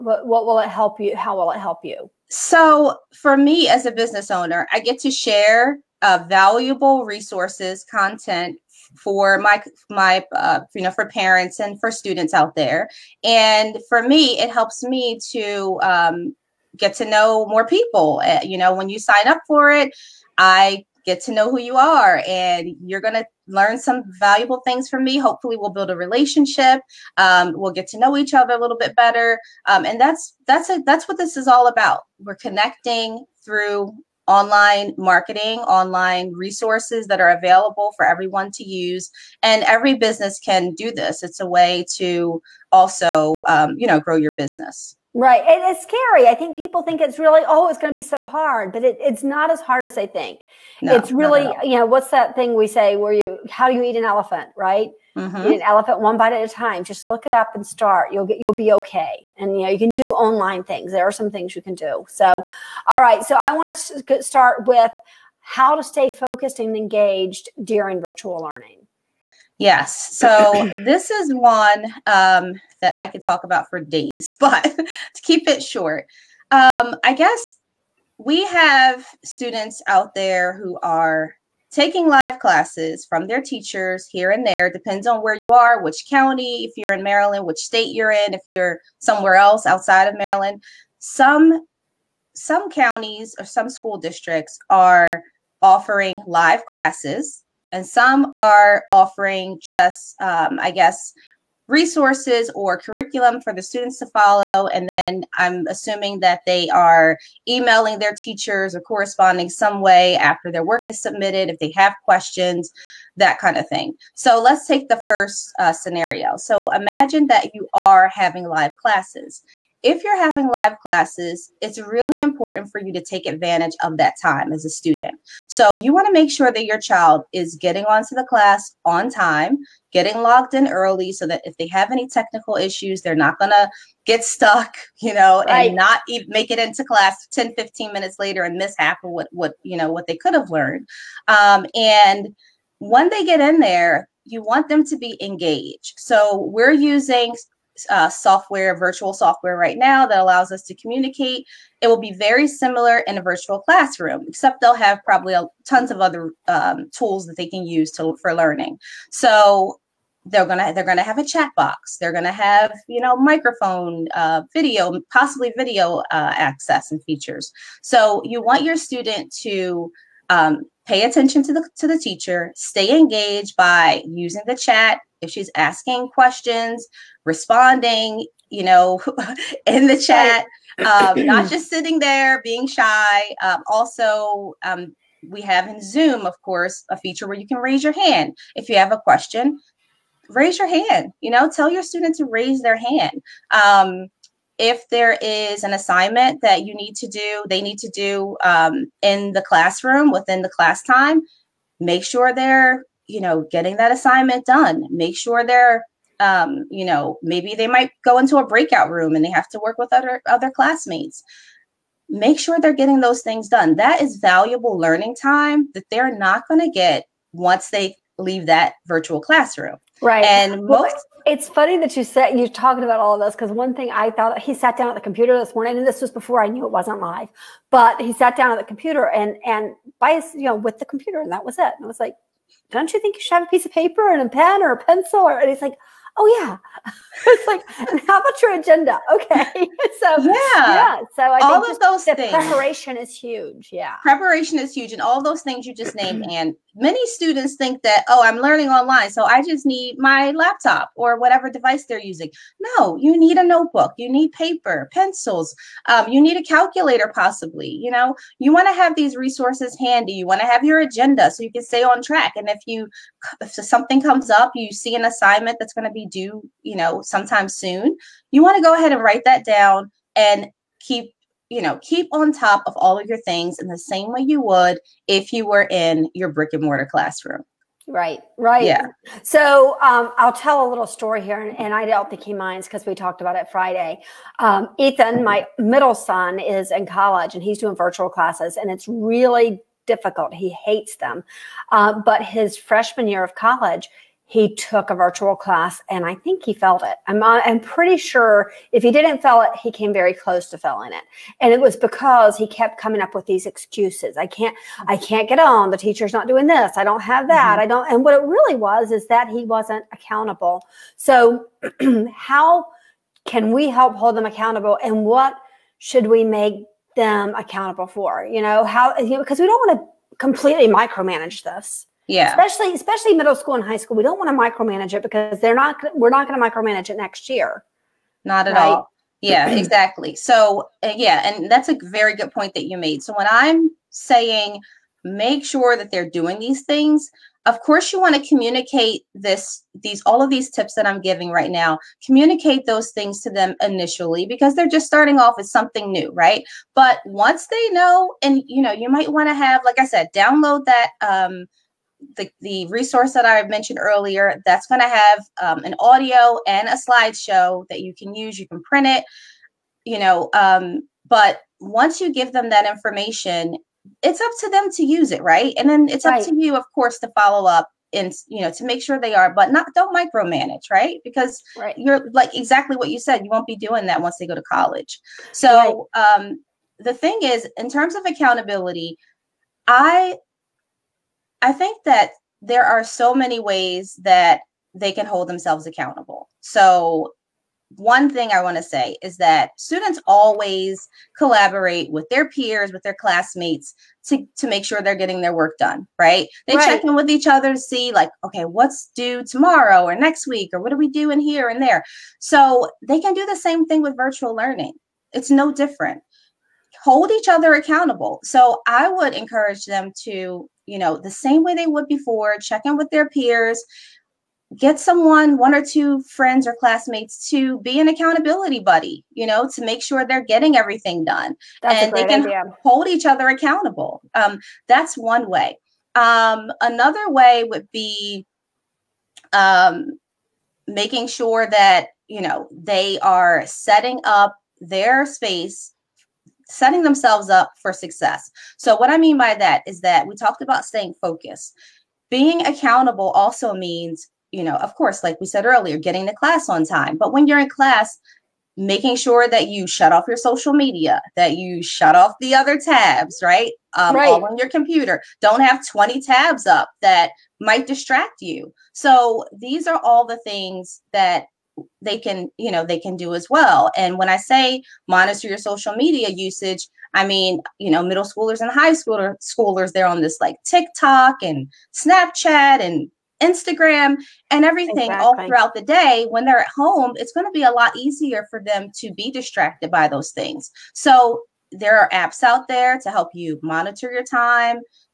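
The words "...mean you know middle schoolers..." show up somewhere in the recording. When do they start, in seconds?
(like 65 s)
467 s.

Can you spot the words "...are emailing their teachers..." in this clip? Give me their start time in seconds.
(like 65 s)
106 s.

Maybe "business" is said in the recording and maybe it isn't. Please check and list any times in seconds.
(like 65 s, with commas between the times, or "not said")
3 s, 39 s, 44 s.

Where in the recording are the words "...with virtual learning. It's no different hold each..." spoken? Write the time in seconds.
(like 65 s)
403 s.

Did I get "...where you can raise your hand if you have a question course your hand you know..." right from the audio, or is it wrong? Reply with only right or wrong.
wrong.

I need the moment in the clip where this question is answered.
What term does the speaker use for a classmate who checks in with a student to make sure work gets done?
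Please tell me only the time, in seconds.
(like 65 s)
417 s.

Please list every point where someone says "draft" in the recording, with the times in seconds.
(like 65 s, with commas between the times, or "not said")
not said.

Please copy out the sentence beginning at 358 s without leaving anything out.
You can print it, you know, um, but once you give them that information, it's up to them to use it, right?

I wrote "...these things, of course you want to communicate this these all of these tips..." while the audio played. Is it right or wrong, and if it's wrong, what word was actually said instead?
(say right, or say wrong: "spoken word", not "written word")
right.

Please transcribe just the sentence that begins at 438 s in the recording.
So, what I mean by that is that we talked about staying focused.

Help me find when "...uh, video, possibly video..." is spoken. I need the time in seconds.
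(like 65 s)
164 s.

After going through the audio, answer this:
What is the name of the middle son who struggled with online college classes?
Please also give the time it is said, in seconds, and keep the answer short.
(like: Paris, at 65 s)
Ethan, at 284 s.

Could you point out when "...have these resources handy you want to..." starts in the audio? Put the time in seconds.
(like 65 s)
258 s.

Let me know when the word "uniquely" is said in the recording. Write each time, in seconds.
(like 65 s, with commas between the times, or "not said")
not said.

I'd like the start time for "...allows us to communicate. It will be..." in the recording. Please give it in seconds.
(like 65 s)
150 s.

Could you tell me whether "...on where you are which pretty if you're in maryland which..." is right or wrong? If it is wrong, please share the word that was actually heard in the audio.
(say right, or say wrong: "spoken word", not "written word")
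wrong: "county", not "pretty".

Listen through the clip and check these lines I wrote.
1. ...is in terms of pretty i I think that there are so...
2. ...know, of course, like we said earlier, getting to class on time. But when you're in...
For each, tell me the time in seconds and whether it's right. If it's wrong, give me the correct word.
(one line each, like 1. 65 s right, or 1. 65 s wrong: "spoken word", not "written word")
1. 377 s wrong: "accountability", not "pretty"
2. 444 s right.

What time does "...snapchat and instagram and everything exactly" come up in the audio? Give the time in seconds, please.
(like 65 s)
471 s.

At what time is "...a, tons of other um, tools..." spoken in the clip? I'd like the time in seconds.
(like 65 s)
155 s.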